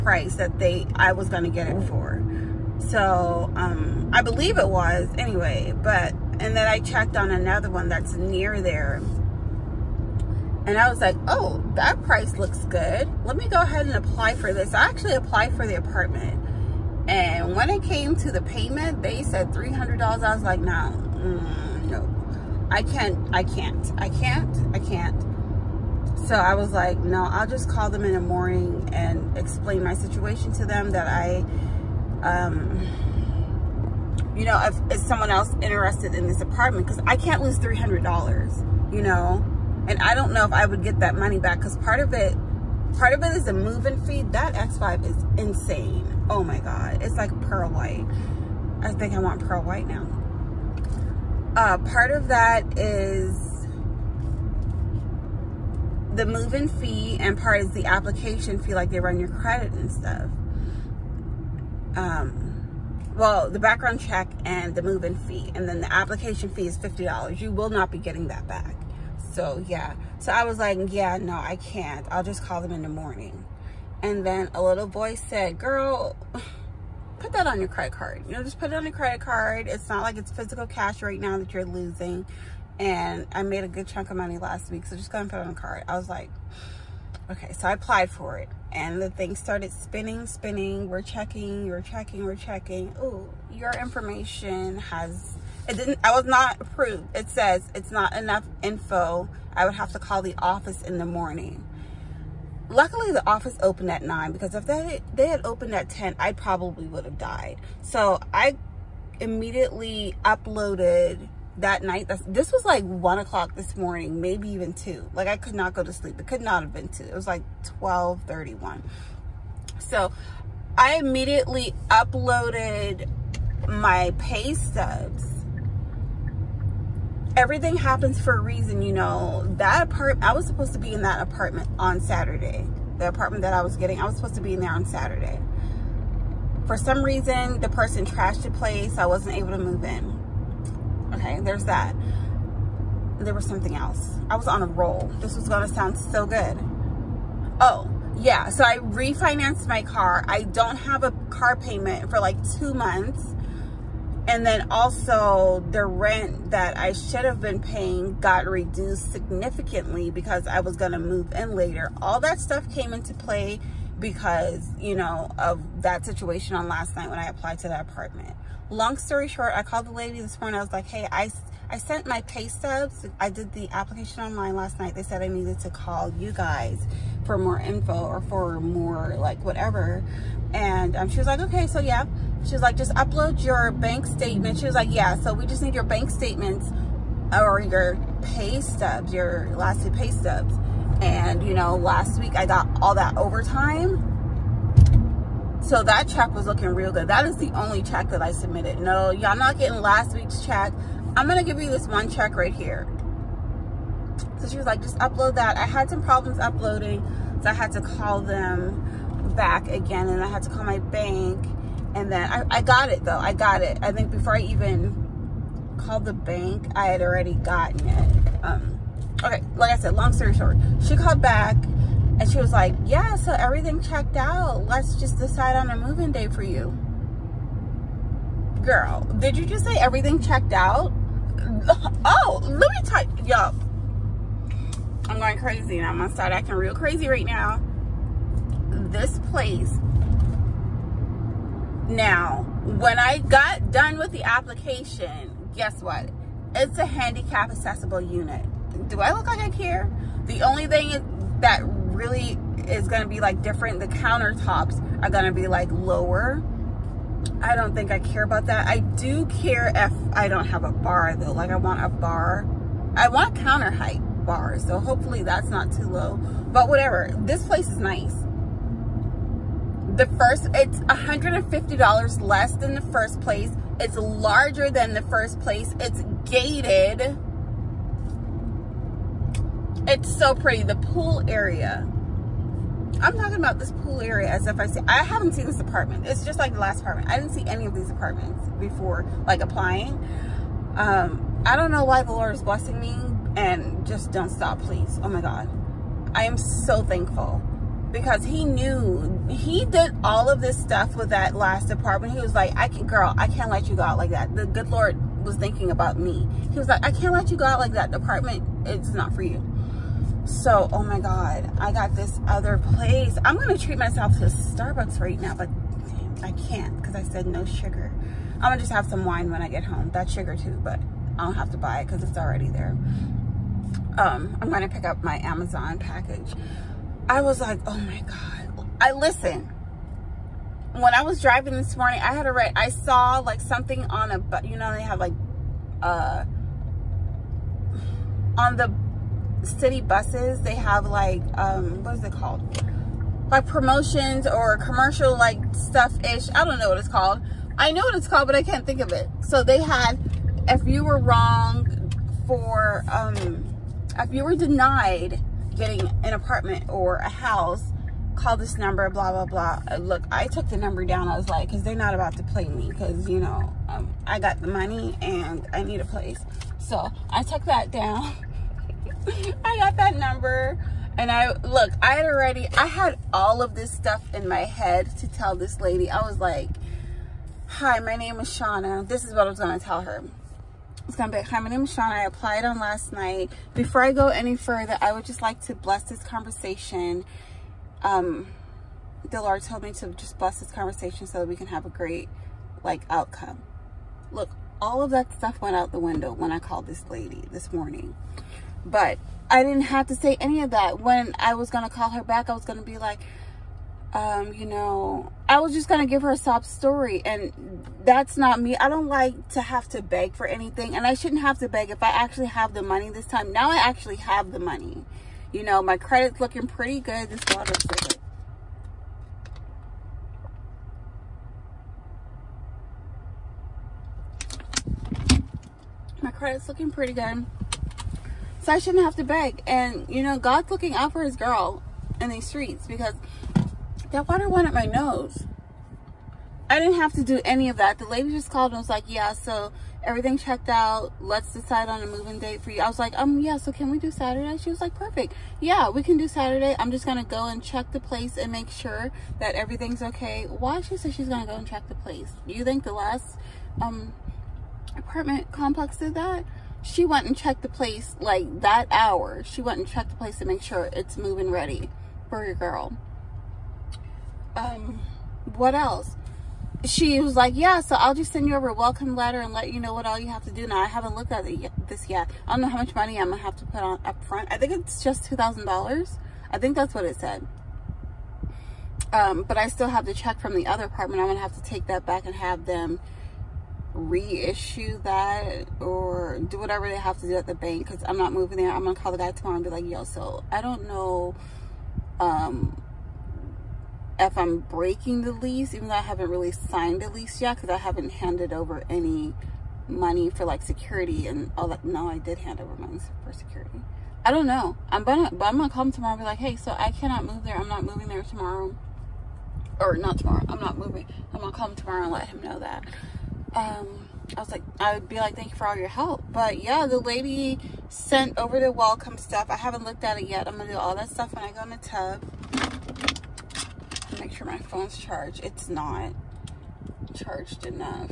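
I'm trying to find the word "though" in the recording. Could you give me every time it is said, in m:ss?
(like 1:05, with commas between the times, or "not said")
3:33, 4:21, 8:15.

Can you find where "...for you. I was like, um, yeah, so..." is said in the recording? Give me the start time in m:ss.
7:22.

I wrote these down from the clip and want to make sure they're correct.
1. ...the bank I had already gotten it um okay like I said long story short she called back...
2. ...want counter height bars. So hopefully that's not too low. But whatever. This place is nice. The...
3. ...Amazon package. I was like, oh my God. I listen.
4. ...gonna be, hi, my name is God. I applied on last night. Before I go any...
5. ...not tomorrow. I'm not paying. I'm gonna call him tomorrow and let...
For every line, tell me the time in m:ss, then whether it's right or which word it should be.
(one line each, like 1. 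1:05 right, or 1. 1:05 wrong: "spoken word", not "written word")
1. 3:36 right
2. 4:23 right
3. 5:25 right
4. 6:20 wrong: "Sean", not "God"
5. 8:29 wrong: "moving", not "paying".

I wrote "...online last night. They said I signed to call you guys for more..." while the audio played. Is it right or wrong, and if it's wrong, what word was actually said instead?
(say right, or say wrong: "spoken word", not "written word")
wrong: "needed", not "signed".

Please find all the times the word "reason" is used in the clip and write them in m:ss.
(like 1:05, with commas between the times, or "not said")
2:08, 2:17.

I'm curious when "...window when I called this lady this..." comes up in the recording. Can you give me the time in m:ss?
6:35.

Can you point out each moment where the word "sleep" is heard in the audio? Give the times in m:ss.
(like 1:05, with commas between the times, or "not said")
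1:55.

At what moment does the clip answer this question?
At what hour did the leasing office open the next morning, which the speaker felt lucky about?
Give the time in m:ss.
1:44.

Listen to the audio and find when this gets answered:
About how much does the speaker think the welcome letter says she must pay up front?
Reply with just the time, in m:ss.
7:55.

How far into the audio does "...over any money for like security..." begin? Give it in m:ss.
8:18.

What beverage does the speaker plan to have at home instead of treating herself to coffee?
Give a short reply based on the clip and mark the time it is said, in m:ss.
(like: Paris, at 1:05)
wine, at 5:19.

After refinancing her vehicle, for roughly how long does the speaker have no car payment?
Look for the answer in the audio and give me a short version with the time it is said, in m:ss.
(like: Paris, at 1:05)
two months, at 2:32.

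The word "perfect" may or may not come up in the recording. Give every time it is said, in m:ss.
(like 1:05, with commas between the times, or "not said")
7:24.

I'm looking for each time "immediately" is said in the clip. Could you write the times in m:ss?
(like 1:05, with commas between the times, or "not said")
1:49, 2:00.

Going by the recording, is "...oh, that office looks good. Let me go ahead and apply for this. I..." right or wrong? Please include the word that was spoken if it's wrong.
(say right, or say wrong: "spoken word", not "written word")
wrong: "price", not "office".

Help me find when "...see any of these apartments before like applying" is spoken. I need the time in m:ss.
4:47.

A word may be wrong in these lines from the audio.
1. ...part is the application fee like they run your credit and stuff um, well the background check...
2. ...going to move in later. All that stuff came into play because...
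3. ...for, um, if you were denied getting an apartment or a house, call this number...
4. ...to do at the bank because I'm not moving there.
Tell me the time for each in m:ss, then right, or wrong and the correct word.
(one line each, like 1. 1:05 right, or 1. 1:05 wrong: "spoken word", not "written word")
1. 0:57 right
2. 2:40 right
3. 5:52 right
4. 8:07 right.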